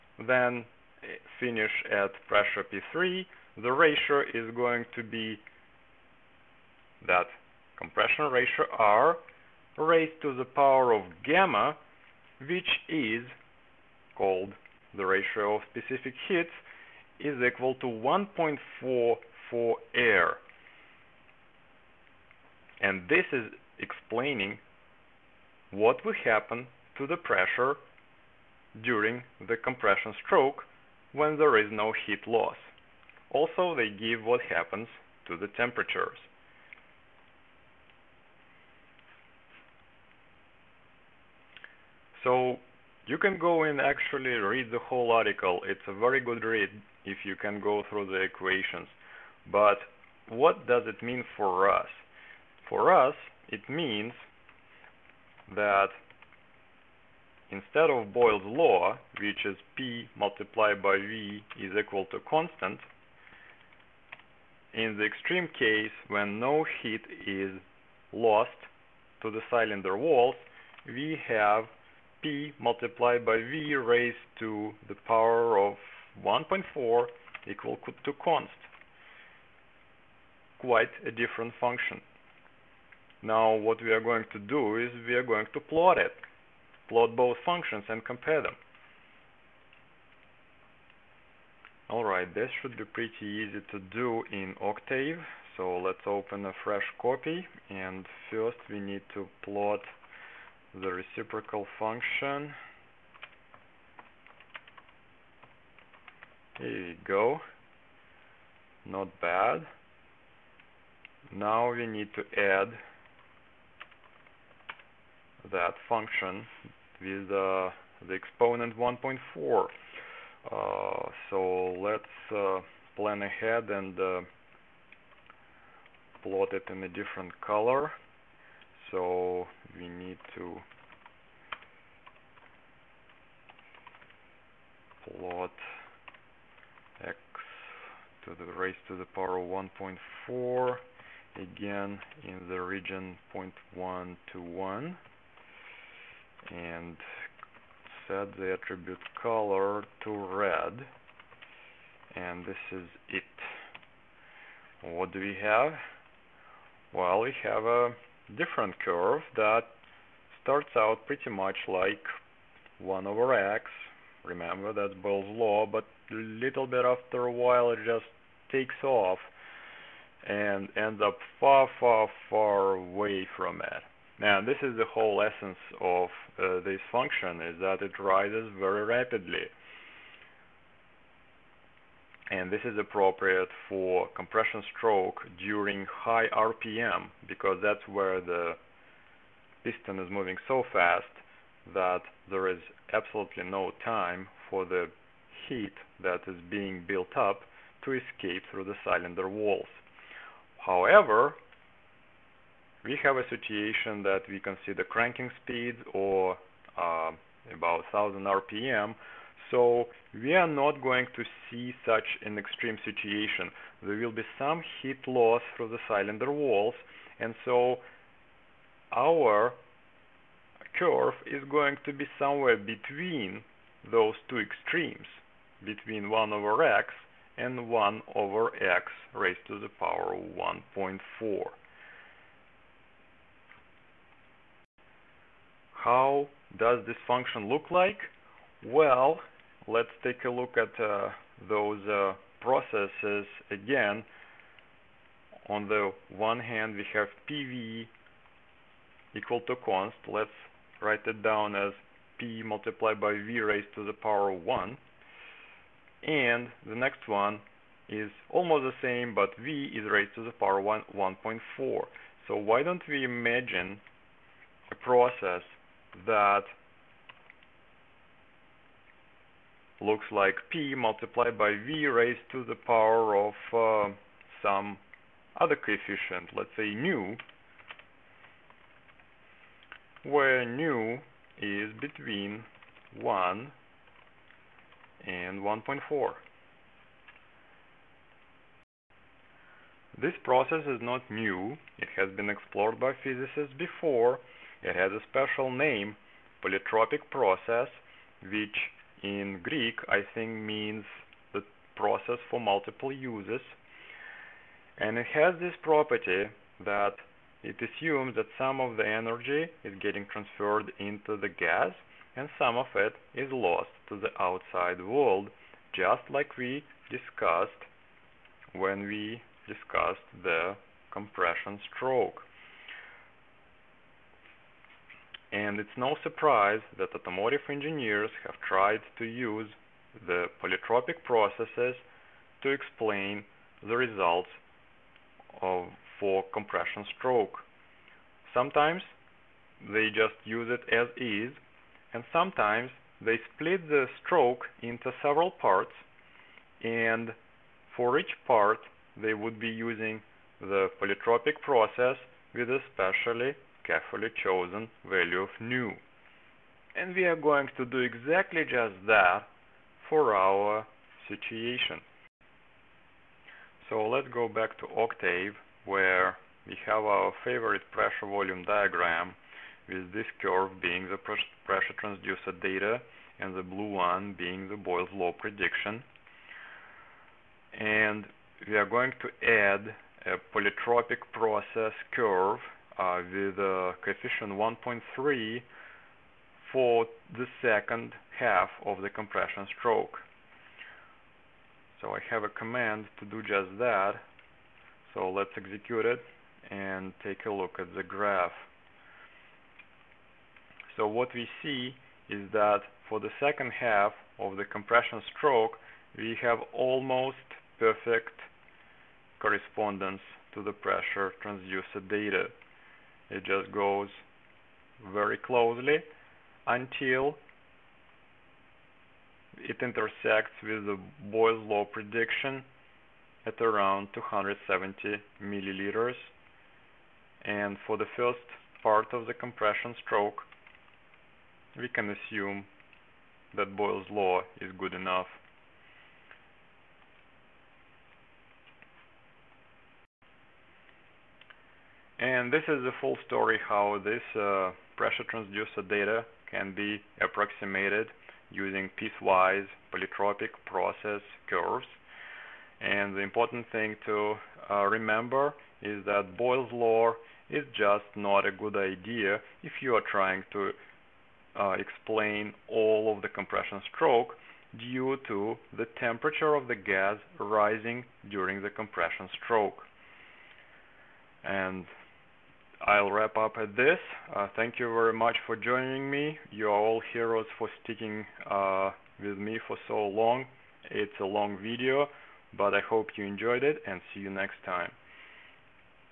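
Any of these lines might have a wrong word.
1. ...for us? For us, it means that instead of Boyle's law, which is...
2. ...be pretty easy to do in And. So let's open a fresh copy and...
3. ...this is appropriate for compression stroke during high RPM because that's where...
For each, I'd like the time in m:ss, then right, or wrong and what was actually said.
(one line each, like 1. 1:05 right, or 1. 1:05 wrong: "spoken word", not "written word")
1. 0:51 right
2. 1:32 wrong: "Octave", not "And"
3. 3:02 right.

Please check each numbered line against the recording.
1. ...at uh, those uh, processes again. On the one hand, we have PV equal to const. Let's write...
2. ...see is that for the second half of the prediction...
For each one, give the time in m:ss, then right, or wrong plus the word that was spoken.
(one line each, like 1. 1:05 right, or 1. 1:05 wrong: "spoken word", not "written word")
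1. 4:00 right
2. 6:41 wrong: "compression", not "prediction".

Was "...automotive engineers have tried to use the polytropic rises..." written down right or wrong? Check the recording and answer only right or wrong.
wrong.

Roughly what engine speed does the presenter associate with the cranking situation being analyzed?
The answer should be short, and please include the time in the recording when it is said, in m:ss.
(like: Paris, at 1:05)
1000 RPM, at 3:27.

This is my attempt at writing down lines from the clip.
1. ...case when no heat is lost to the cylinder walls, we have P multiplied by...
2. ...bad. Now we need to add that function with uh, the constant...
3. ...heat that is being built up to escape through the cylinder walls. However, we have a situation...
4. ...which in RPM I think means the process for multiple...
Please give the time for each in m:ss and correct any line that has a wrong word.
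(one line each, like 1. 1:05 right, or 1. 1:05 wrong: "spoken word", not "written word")
1. 1:05 right
2. 1:49 wrong: "exponent", not "constant"
3. 3:15 right
4. 4:58 wrong: "Greek", not "RPM".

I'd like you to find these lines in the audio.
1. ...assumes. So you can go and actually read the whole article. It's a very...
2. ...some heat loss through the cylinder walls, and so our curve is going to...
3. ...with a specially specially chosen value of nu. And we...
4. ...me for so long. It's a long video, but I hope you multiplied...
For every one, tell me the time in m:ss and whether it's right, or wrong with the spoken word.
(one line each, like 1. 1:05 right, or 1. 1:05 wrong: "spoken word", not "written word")
1. 0:35 wrong: "temperatures", not "assumes"
2. 3:34 right
3. 5:52 wrong: "carefully", not "specially"
4. 7:59 wrong: "enjoyed", not "multiplied".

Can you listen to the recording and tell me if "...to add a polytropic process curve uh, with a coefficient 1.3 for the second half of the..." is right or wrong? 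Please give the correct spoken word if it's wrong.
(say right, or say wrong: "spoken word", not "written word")
right.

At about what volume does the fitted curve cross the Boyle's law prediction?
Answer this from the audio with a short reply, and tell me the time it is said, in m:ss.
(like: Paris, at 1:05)
270 milliliters, at 7:03.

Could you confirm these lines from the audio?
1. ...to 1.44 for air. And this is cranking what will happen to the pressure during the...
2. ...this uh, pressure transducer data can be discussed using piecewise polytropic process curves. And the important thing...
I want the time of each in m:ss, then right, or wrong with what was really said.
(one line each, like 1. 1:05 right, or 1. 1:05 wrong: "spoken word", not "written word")
1. 0:17 wrong: "explaining", not "cranking"
2. 7:23 wrong: "approximated", not "discussed".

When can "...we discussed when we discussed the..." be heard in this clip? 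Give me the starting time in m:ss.
5:16.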